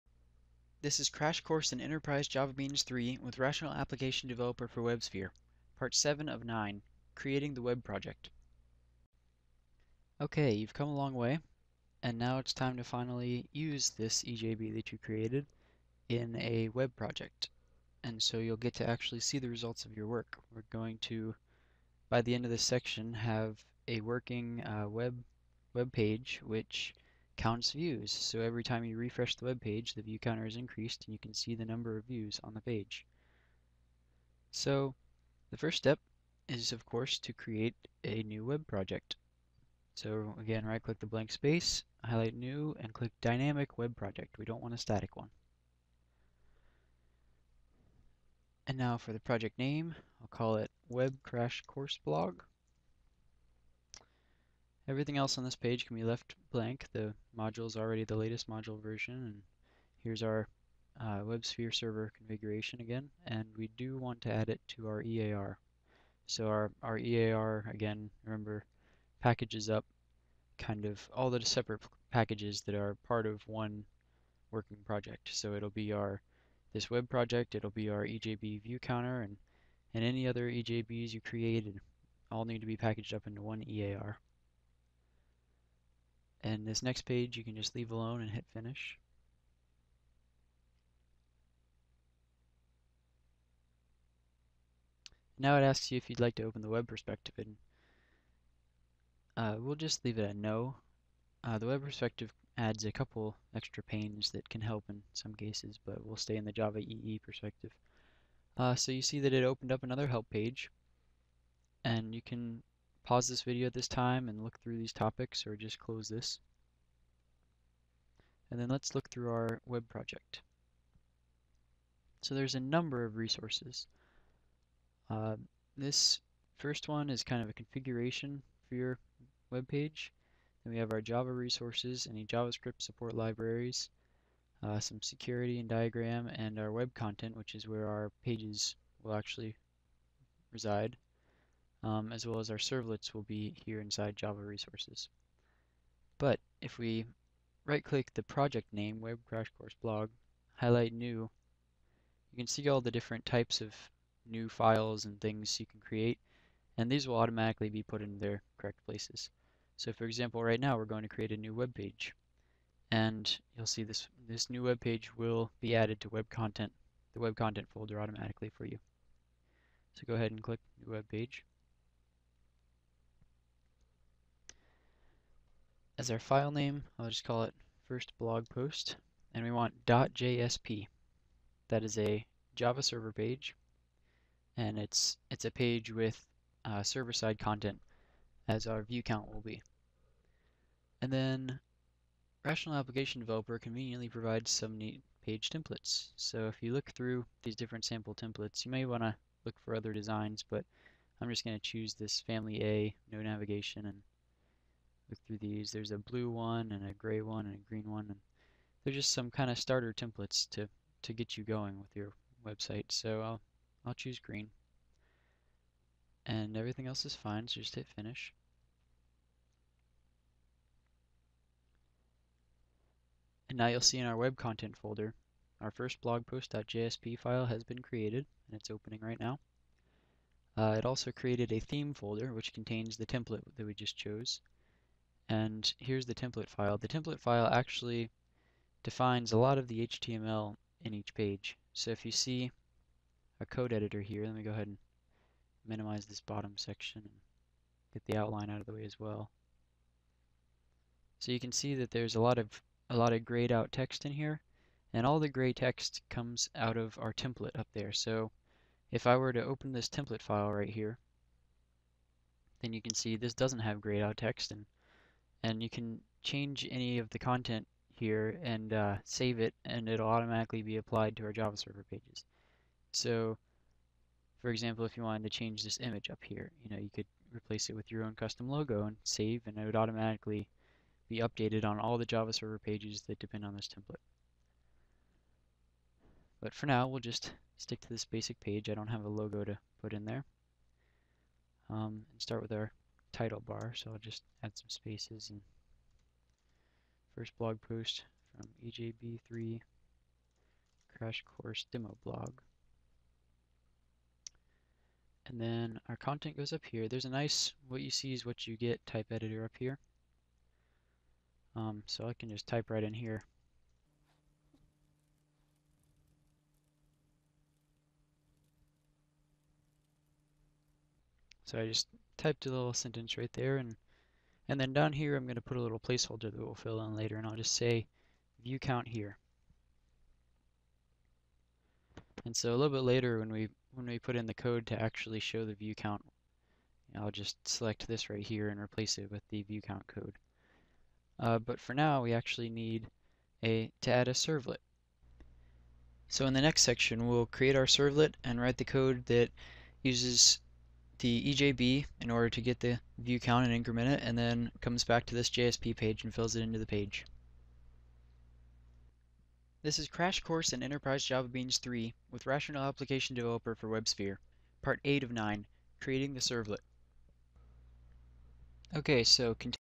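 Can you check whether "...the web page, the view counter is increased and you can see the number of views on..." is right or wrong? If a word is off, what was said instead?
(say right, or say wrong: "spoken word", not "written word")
right.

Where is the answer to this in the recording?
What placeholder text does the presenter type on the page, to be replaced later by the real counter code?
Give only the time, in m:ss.
5:28.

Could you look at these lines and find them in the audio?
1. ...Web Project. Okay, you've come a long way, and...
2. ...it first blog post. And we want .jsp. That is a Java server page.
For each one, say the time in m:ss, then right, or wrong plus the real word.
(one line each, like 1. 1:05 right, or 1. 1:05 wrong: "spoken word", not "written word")
1. 0:07 right
2. 2:57 right.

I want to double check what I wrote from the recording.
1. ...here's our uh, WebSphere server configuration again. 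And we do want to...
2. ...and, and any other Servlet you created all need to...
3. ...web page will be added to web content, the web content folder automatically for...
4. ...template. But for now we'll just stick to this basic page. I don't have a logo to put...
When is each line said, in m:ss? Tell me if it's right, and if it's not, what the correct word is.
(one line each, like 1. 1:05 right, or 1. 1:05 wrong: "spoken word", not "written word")
1. 1:00 right
2. 1:19 wrong: "EJBs", not "Servlet"
3. 2:44 right
4. 4:43 right.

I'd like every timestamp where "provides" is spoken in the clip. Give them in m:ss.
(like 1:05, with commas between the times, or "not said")
3:14.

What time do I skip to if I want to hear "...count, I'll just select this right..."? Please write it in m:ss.
5:35.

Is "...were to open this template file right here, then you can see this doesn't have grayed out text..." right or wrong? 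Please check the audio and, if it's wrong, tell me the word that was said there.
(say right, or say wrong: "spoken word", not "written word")
right.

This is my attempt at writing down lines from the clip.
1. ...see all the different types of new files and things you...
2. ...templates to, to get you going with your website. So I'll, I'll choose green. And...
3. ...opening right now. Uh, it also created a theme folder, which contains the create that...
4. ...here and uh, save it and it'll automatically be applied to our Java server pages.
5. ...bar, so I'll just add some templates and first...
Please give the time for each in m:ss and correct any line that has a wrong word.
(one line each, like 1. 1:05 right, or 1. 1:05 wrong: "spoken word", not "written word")
1. 2:32 right
2. 3:29 right
3. 3:48 wrong: "template", not "create"
4. 4:27 right
5. 4:53 wrong: "spaces", not "templates".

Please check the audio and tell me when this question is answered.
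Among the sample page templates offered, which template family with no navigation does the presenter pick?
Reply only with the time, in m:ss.
3:22.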